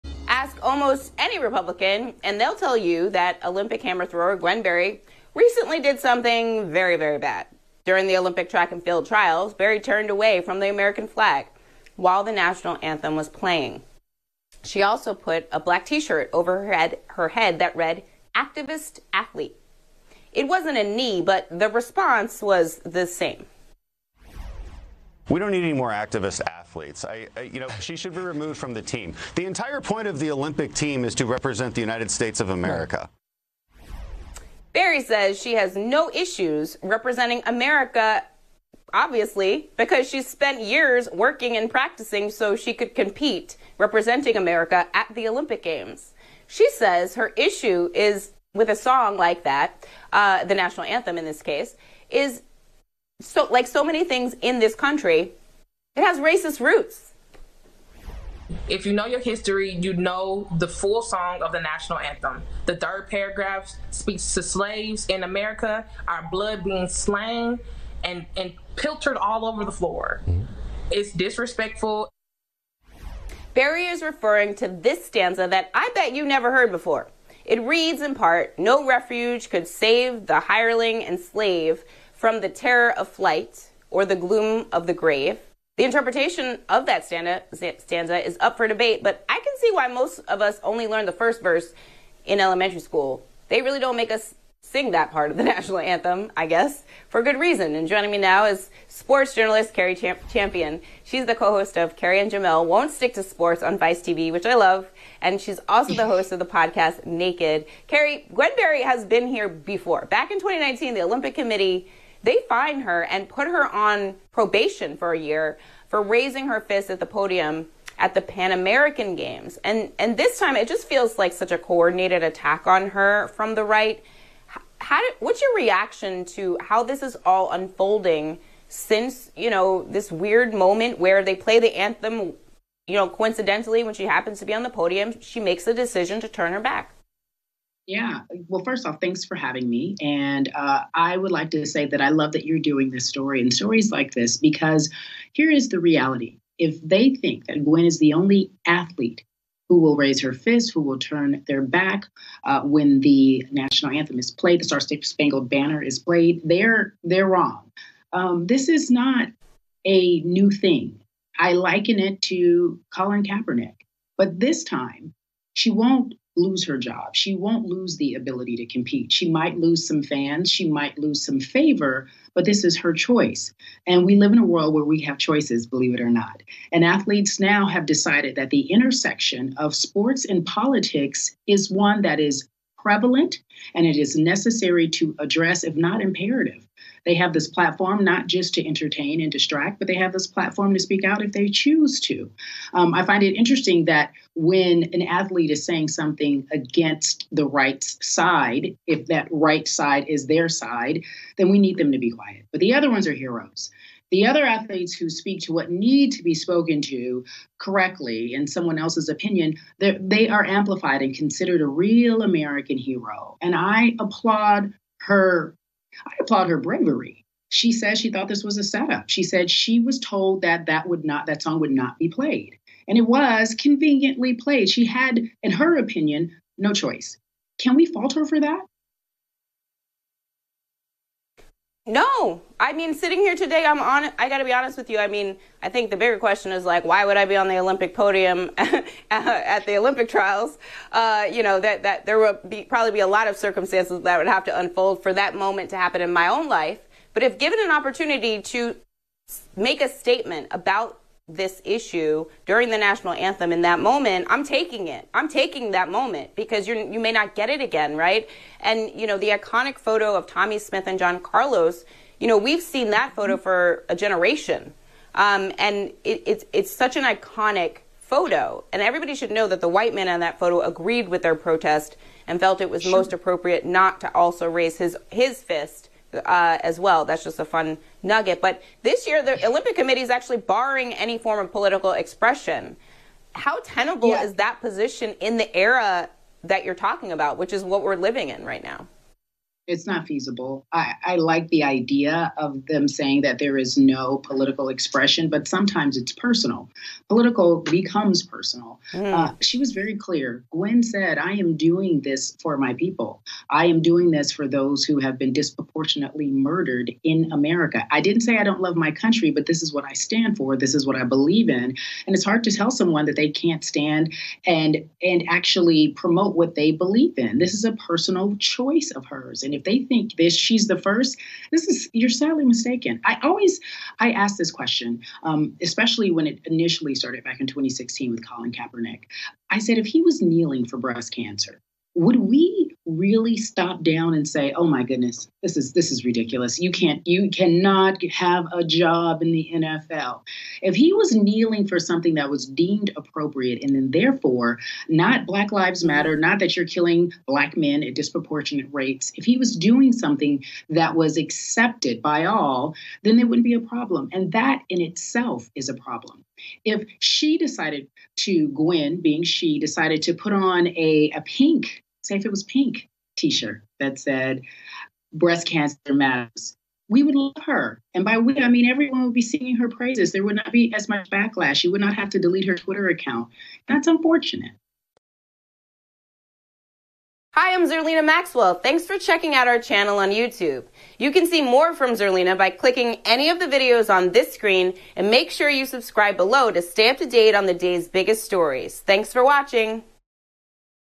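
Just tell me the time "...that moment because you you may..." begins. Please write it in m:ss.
4:15.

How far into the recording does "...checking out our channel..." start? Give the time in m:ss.
6:18.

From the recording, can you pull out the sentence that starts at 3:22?
But the other ones are heroes.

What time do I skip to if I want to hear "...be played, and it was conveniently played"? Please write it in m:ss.
3:41.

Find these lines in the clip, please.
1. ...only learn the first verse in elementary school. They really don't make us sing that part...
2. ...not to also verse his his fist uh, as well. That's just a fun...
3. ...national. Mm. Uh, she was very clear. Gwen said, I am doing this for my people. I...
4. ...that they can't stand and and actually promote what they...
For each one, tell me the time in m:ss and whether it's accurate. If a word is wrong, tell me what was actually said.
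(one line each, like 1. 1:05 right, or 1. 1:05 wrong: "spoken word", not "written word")
1. 1:30 right
2. 4:33 wrong: "raise", not "verse"
3. 4:58 wrong: "personal", not "national"
4. 5:13 right.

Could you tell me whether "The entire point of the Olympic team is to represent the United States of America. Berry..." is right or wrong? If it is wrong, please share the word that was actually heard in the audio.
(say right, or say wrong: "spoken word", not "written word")
right.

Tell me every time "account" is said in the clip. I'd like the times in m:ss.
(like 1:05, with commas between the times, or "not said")
6:12.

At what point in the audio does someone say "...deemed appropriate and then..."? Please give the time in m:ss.
5:42.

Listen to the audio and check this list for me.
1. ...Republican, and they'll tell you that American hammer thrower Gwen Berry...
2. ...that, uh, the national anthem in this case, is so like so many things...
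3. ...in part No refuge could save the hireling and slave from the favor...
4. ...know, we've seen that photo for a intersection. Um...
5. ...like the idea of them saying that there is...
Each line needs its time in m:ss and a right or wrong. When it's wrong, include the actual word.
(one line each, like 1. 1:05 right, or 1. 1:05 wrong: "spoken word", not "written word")
1. 0:01 wrong: "Olympic", not "American"
2. 0:49 right
3. 1:18 wrong: "terror", not "favor"
4. 4:22 wrong: "generation", not "intersection"
5. 4:51 right.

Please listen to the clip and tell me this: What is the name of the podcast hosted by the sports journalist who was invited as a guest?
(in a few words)
Naked.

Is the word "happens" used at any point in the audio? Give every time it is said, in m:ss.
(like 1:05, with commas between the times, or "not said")
2:14, 4:05.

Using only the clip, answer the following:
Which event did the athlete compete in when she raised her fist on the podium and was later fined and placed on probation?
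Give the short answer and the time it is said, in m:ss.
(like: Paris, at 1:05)
Pan American Games, at 1:58.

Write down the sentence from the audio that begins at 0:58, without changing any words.
If you know your history, you know the full song of the national anthem.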